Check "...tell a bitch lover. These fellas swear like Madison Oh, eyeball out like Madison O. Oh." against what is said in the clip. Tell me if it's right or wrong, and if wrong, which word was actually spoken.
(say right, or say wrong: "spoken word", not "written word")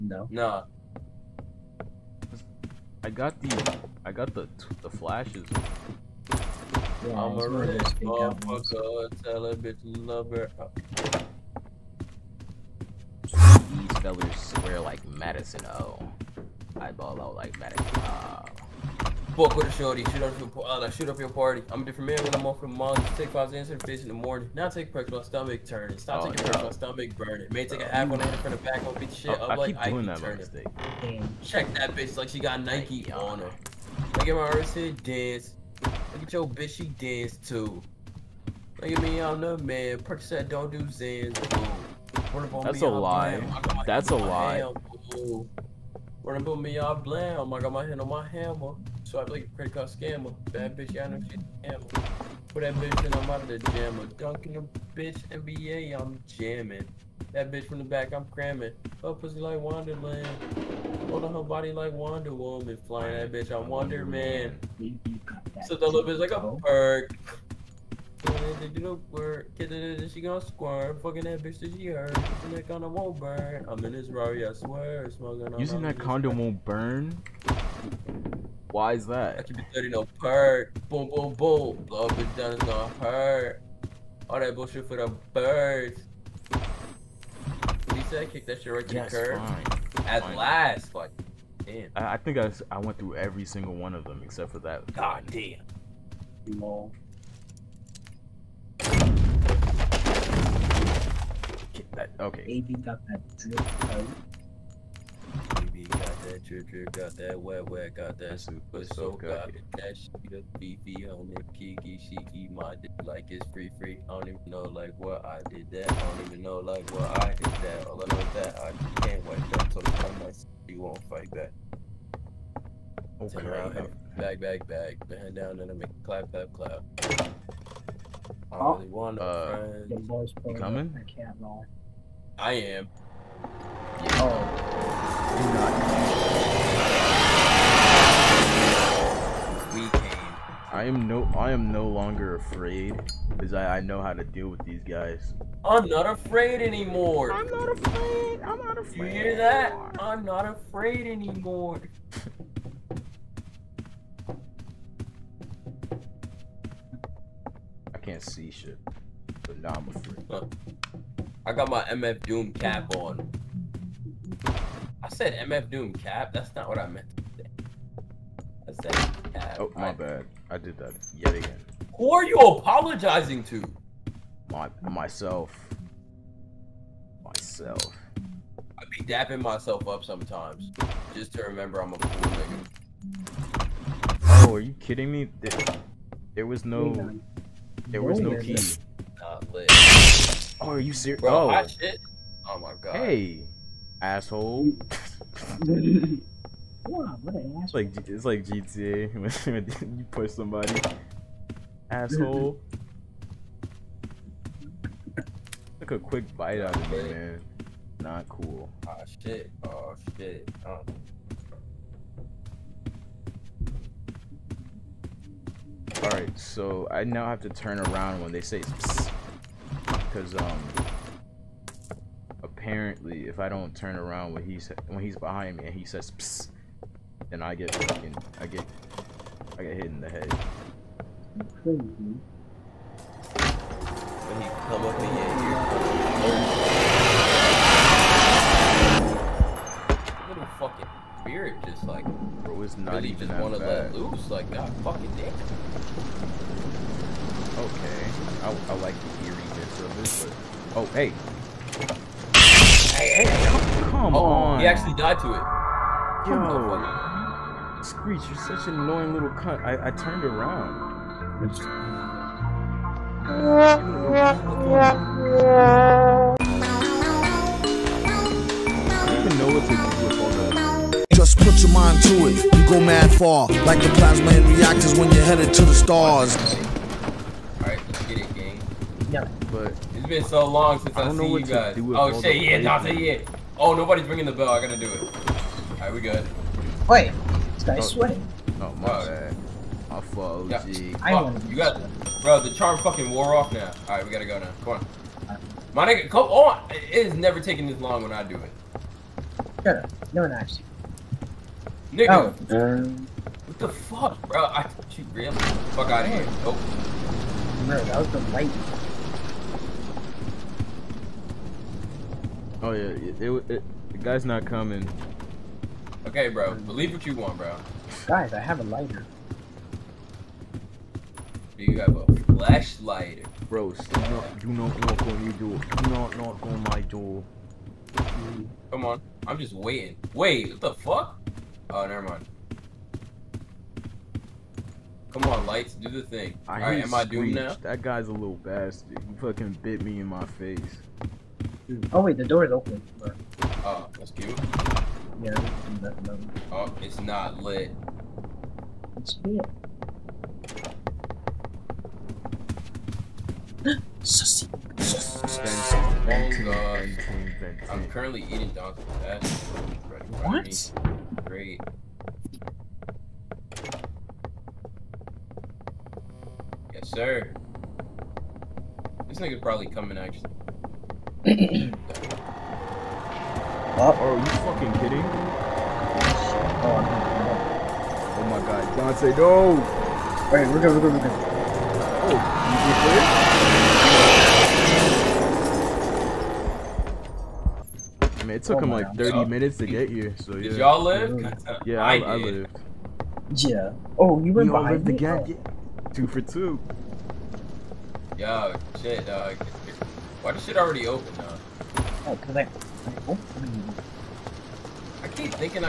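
right.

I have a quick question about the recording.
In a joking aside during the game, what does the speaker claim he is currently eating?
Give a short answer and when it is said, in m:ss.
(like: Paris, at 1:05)
Donkey fat, at 5:58.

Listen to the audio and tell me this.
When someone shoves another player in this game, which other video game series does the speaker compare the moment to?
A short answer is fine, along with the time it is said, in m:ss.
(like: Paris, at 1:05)
GTA, at 3:18.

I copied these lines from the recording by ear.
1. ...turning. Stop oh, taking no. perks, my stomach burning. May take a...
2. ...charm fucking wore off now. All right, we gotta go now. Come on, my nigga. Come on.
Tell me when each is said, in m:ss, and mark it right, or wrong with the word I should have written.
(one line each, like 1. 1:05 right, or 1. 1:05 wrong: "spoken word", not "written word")
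1. 0:25 right
2. 4:52 right.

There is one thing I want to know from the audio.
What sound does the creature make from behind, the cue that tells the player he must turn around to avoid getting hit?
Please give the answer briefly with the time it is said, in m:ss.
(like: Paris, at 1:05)
psst, at 3:46.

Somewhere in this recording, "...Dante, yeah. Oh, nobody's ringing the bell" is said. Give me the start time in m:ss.
4:42.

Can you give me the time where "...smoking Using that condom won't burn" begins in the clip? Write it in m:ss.
1:15.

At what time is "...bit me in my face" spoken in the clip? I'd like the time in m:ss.
5:39.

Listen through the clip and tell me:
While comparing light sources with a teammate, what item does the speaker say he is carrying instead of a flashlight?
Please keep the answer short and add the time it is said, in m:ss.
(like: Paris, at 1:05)
A lighter, at 5:18.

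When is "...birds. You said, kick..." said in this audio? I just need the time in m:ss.
1:25.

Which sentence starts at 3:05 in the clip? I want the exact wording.
There, there was no, there was no key.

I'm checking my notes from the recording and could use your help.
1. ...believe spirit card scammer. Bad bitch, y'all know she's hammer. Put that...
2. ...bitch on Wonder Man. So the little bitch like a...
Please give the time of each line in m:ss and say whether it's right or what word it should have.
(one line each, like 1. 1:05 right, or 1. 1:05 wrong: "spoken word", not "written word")
1. 0:49 wrong: "credit", not "spirit"
2. 1:03 right.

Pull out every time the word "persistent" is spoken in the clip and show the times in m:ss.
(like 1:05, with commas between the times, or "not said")
not said.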